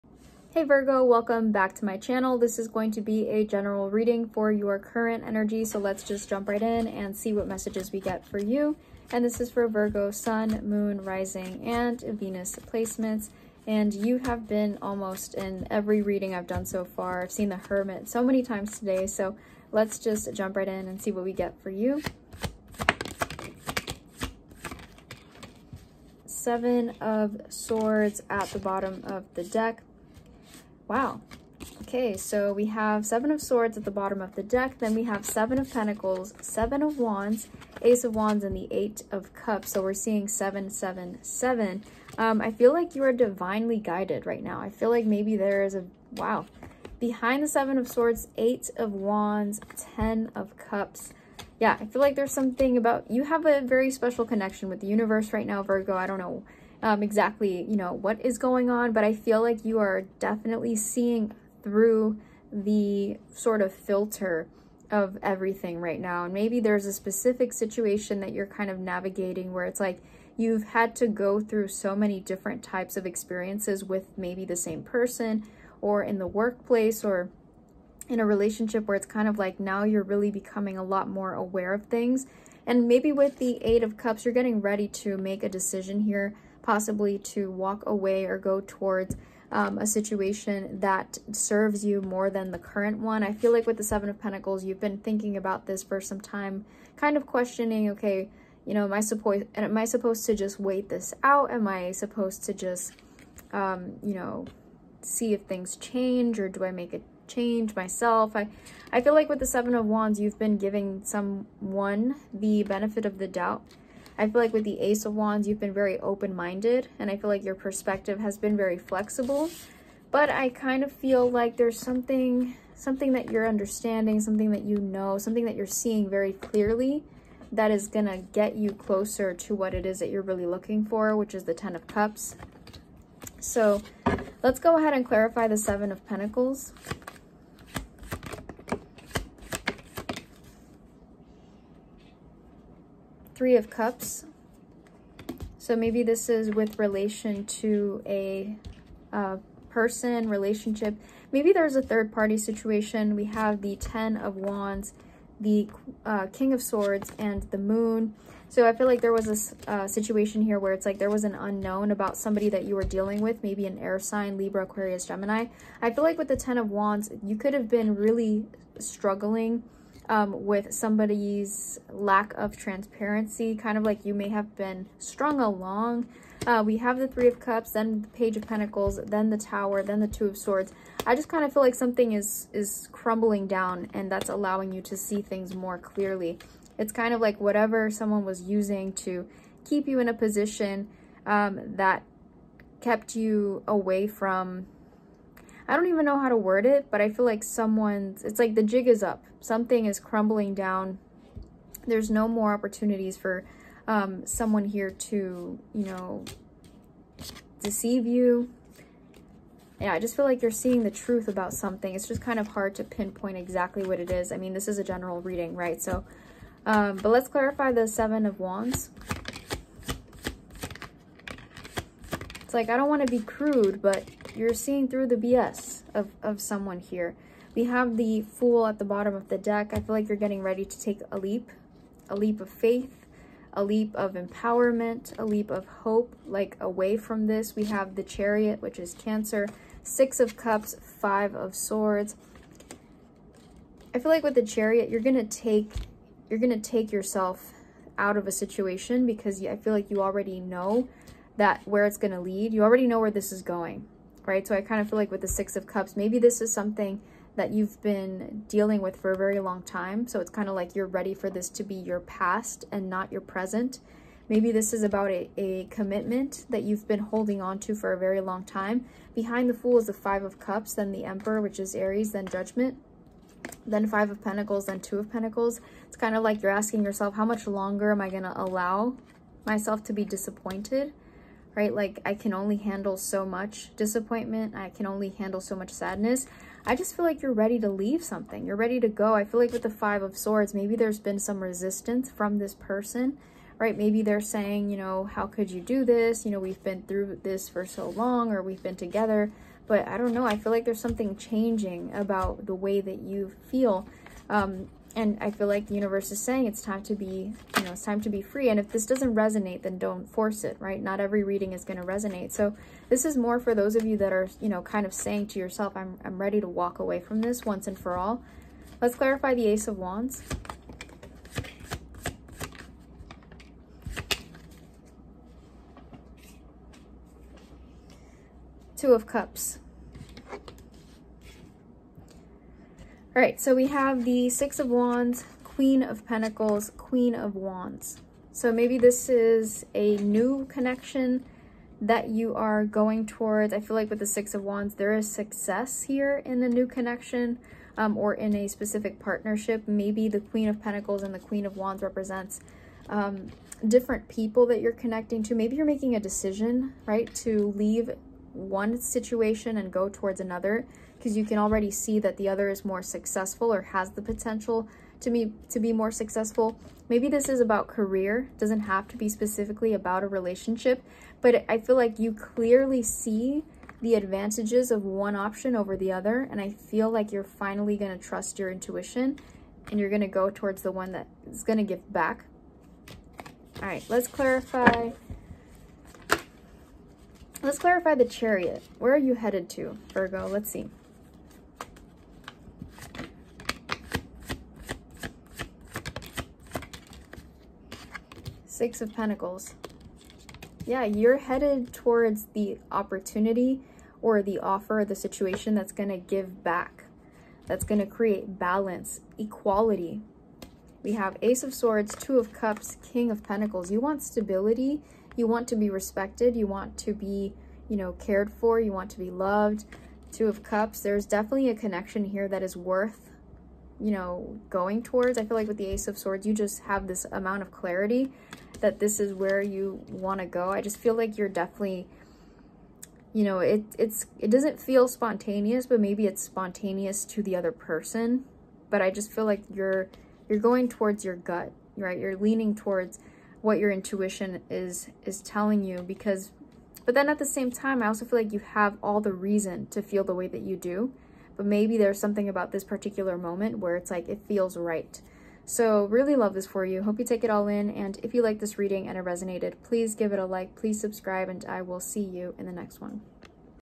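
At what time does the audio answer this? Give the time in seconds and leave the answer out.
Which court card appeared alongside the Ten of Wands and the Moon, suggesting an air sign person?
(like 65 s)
156 s.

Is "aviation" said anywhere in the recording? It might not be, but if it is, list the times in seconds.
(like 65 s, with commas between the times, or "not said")
not said.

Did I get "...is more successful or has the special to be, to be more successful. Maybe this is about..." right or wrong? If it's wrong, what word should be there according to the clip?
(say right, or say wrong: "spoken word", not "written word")
wrong: "potential", not "special".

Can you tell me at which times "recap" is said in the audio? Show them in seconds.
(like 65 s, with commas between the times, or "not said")
not said.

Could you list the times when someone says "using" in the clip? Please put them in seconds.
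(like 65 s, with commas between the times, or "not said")
188 s.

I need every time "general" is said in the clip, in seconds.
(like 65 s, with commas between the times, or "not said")
3 s, 214 s.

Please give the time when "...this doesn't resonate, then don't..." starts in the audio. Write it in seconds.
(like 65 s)
308 s.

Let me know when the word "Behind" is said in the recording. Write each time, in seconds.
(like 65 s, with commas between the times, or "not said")
46 s, 269 s.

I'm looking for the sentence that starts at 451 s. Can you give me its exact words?
But maybe there's something about this particular moment where it's like, it feels right so really love this for you.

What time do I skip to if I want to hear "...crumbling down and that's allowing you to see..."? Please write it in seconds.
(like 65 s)
182 s.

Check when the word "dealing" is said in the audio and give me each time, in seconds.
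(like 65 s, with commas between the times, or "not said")
162 s, 258 s.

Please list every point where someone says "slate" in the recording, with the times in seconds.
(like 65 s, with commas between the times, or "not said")
not said.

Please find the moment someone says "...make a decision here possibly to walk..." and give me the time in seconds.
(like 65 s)
85 s.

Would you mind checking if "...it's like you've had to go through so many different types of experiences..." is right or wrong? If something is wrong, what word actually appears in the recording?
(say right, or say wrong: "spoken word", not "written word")
right.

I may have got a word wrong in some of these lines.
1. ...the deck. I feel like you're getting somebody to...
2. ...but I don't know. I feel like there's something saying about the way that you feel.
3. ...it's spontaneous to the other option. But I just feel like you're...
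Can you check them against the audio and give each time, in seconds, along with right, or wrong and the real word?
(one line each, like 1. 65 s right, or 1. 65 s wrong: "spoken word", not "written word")
1. 229 s wrong: "ready", not "somebody"
2. 299 s wrong: "changing", not "saying"
3. 436 s wrong: "person", not "option".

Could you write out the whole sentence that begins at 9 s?
And this is for Virgo Sun, Moon, Rising, and Venus placements.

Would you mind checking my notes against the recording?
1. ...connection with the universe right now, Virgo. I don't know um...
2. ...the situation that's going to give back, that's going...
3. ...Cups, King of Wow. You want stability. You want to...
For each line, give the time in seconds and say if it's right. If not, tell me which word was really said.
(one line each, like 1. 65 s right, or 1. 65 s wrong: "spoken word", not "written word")
1. 54 s right
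2. 404 s right
3. 412 s wrong: "Pentacles", not "Wow".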